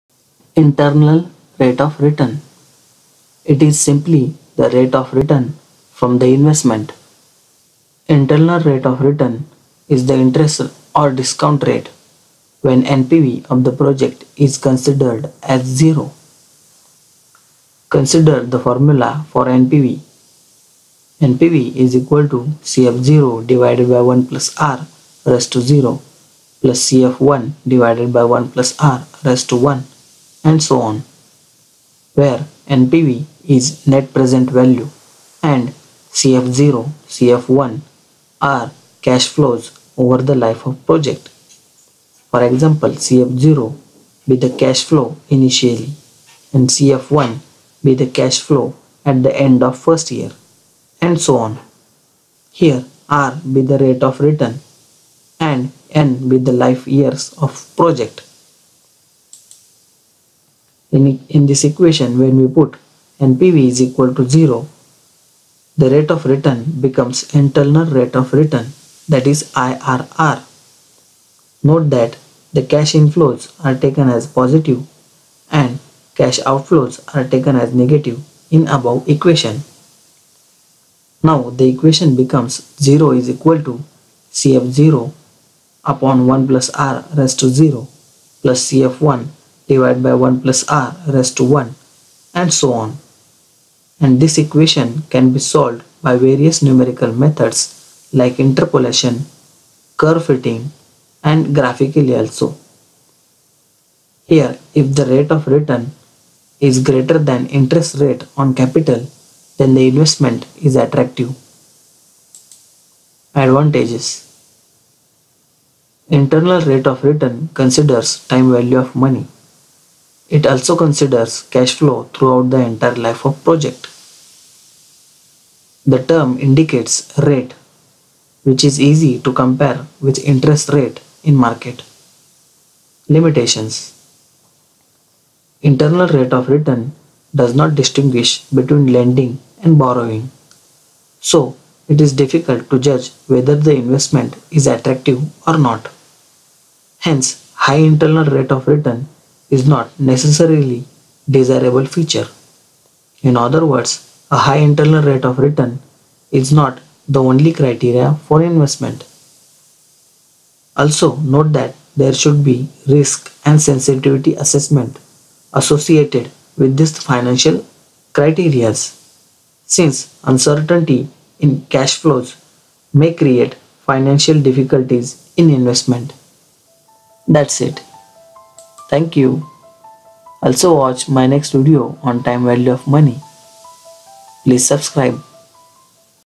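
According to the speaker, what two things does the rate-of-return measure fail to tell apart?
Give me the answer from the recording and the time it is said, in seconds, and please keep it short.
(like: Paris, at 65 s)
Lending and borrowing, at 138 s.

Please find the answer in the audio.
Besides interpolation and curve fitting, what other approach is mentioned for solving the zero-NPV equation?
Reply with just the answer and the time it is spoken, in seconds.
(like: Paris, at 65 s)
Graphically, at 101 s.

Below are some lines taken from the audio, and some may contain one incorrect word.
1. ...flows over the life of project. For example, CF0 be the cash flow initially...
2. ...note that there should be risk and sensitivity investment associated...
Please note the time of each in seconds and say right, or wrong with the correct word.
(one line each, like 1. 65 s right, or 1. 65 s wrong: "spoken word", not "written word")
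1. 39 s right
2. 161 s wrong: "assessment", not "investment".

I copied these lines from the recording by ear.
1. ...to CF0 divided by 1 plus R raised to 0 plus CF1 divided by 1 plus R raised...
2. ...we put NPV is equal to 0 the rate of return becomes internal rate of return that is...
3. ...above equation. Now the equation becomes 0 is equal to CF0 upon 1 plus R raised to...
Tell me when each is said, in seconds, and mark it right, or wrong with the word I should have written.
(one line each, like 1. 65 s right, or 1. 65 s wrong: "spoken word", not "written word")
1. 22 s right
2. 62 s right
3. 78 s right.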